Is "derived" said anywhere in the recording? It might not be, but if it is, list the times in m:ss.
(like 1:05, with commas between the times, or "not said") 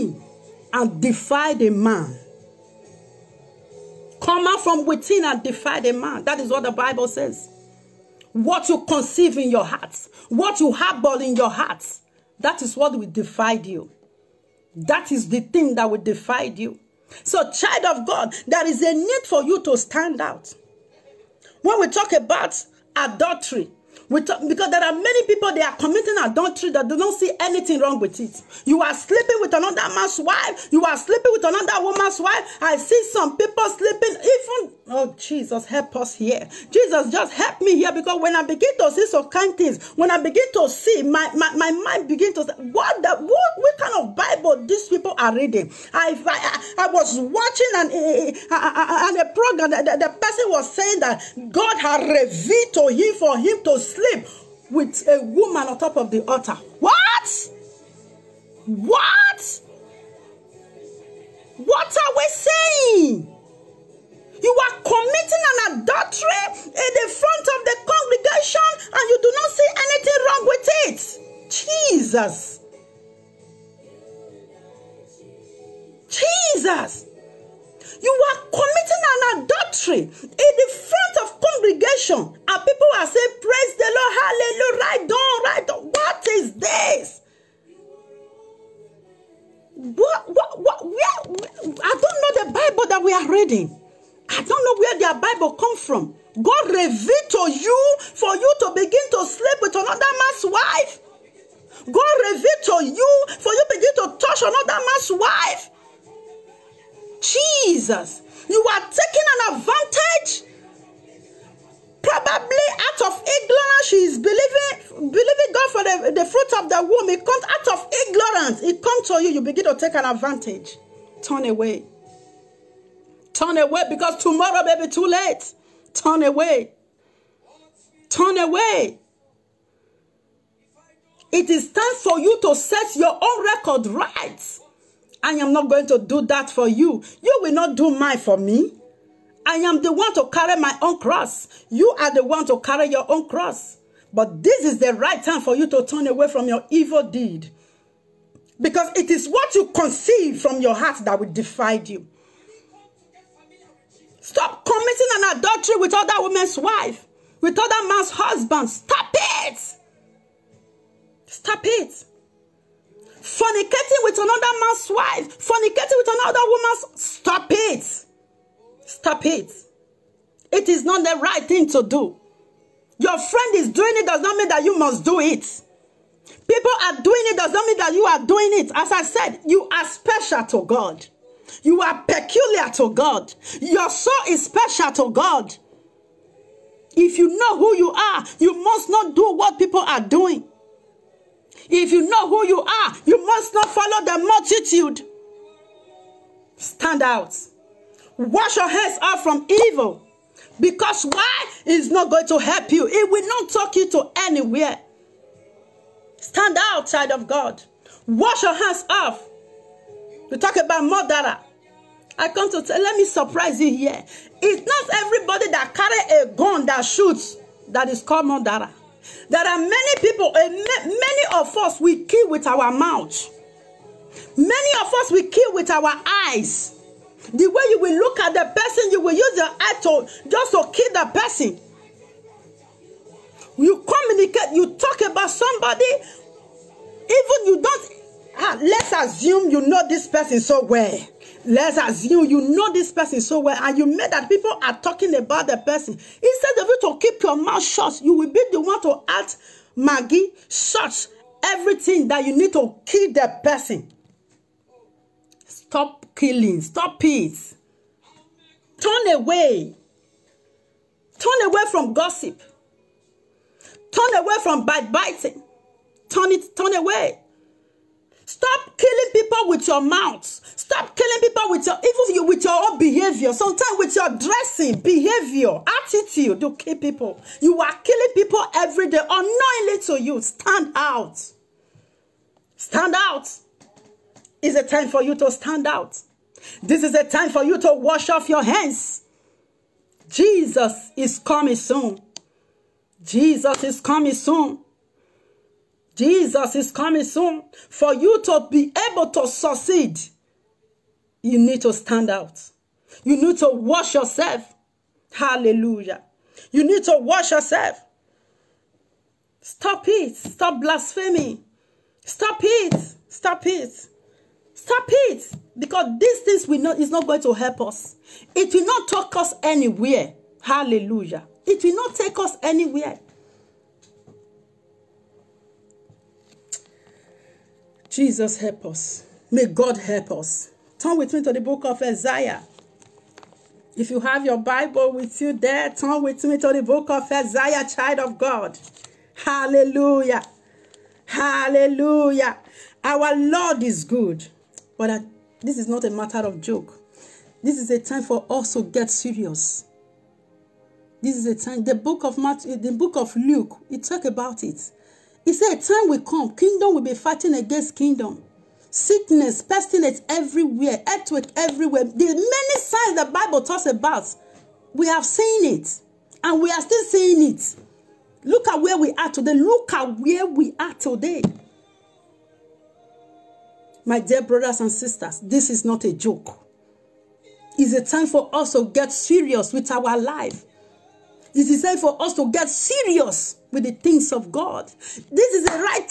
not said.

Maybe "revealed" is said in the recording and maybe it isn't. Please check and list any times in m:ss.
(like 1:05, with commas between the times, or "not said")
0:52, 1:36, 1:42.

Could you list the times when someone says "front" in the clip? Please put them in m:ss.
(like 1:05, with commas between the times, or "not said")
1:07, 1:20.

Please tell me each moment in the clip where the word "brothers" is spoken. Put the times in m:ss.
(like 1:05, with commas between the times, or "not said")
6:14.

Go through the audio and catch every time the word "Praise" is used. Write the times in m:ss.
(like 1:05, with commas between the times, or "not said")
1:23.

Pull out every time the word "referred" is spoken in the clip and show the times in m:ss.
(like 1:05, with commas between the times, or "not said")
not said.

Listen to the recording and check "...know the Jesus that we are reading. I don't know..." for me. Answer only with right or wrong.
wrong.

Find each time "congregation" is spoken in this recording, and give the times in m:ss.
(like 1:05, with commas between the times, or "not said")
1:07, 1:21.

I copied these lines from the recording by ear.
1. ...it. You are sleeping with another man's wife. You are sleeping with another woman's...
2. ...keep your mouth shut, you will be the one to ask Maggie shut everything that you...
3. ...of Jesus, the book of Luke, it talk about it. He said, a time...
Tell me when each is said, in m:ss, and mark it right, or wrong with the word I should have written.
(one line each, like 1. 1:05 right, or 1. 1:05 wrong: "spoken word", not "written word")
1. 0:28 right
2. 4:07 right
3. 5:52 wrong: "Matthew", not "Jesus".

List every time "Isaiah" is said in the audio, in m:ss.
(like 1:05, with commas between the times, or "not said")
5:31, 5:37.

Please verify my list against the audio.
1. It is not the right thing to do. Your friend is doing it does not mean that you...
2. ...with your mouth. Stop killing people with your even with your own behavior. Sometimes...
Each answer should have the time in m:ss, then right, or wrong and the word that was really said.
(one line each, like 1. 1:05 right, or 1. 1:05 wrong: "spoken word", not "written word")
1. 2:50 right
2. 4:29 right.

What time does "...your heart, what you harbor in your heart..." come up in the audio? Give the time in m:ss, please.
0:09.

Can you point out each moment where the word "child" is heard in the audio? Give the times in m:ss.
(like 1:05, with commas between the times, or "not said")
0:17, 3:26, 5:37.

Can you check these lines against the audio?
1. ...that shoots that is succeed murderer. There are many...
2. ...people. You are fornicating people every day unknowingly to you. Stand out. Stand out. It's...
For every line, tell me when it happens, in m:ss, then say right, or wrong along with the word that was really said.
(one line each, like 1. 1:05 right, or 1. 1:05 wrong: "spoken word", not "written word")
1. 3:36 wrong: "called", not "succeed"
2. 4:36 wrong: "killing", not "fornicating".